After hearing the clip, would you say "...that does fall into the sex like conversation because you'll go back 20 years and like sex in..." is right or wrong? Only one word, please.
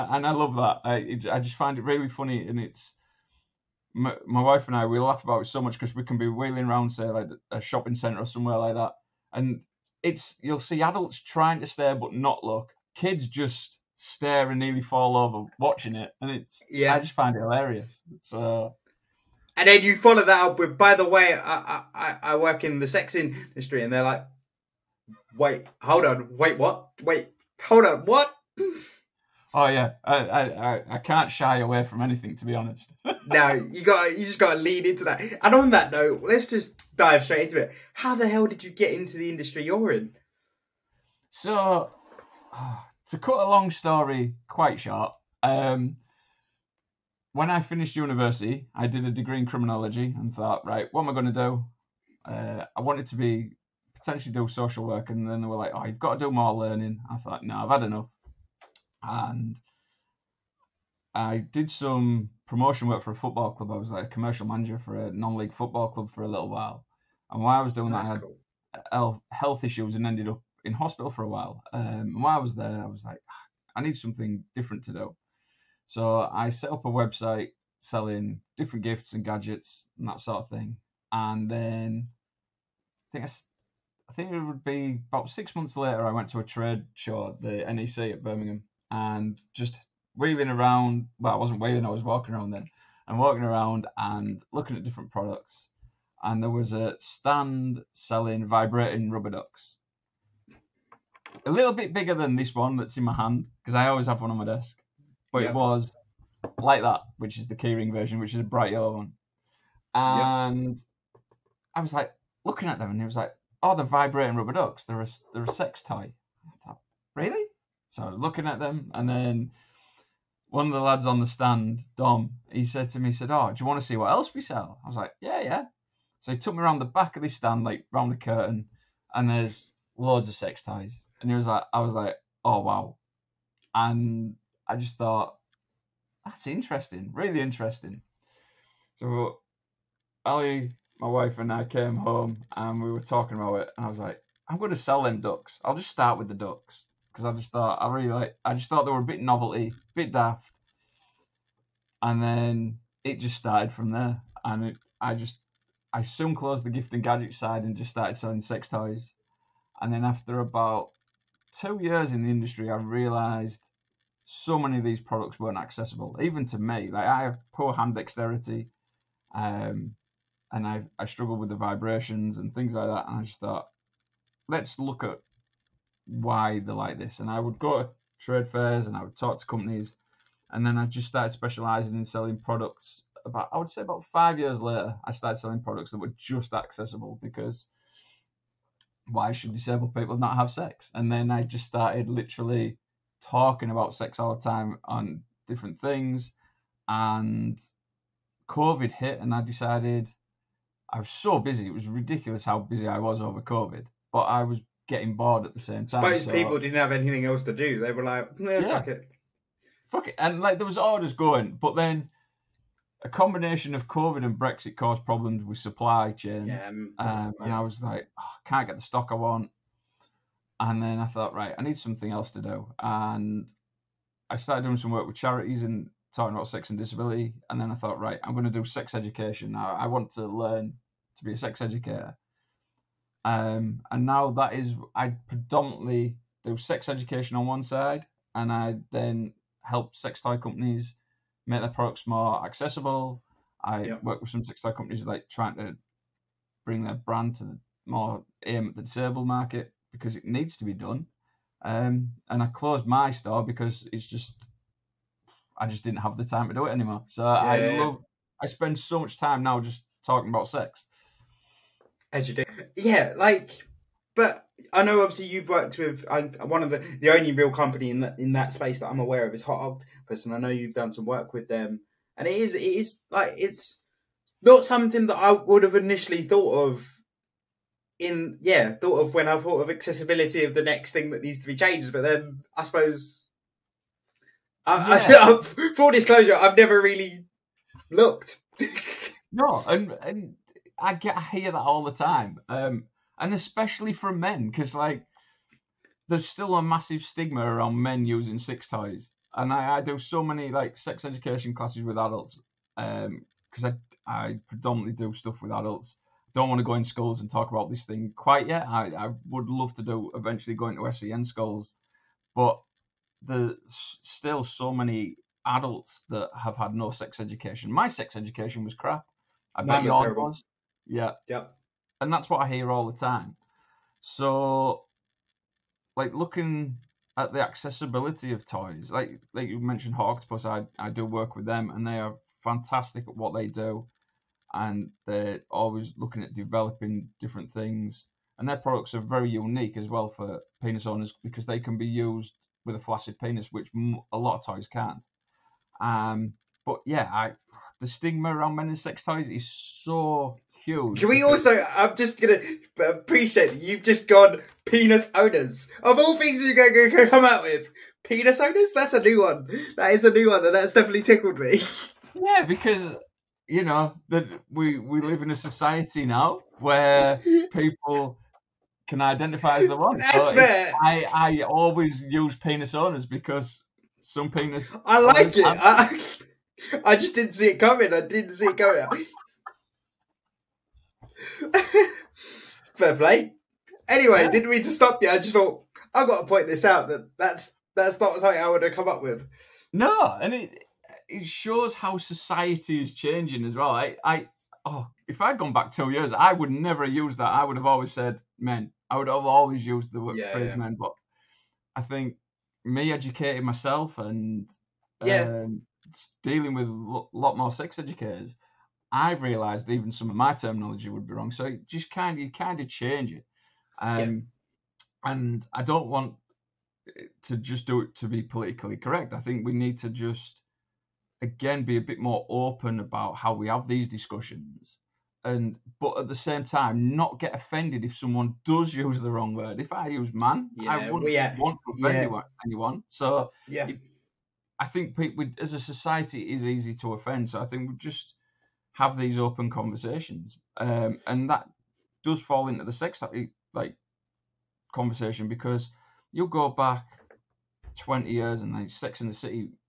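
right.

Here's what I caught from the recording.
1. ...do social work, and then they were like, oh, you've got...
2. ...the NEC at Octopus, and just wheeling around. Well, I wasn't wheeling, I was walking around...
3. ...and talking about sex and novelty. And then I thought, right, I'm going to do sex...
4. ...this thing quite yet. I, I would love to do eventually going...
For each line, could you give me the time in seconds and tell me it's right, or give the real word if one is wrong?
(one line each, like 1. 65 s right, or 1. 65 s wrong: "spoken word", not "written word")
1. 54 s right
2. 87 s wrong: "Birmingham", not "Octopus"
3. 225 s wrong: "disability", not "novelty"
4. 307 s right.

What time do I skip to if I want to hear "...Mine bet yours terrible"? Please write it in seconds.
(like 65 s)
319 s.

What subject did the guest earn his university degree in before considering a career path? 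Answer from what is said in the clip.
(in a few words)
Criminology.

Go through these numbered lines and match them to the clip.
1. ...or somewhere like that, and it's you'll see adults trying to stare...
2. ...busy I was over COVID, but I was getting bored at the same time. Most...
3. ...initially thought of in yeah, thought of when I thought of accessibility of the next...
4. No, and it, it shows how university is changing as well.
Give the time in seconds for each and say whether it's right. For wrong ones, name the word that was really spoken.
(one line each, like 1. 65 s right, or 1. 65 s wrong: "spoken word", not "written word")
1. 8 s right
2. 202 s right
3. 275 s right
4. 389 s wrong: "society", not "university".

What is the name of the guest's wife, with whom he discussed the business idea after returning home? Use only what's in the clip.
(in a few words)
Ali.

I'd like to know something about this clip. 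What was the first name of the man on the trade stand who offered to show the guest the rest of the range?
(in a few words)
Dom.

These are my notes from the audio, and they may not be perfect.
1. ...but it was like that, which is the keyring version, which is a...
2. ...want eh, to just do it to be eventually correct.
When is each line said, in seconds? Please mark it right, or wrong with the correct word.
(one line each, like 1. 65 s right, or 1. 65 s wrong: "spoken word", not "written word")
1. 105 s right
2. 415 s wrong: "politically", not "eventually".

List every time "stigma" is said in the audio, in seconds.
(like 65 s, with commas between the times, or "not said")
297 s, 347 s.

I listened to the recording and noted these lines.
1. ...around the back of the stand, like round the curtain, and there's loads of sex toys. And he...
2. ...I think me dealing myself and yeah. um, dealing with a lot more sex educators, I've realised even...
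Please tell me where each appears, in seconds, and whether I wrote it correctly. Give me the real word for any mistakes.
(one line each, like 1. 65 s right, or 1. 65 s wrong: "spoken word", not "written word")
1. 126 s right
2. 401 s wrong: "educating", not "dealing".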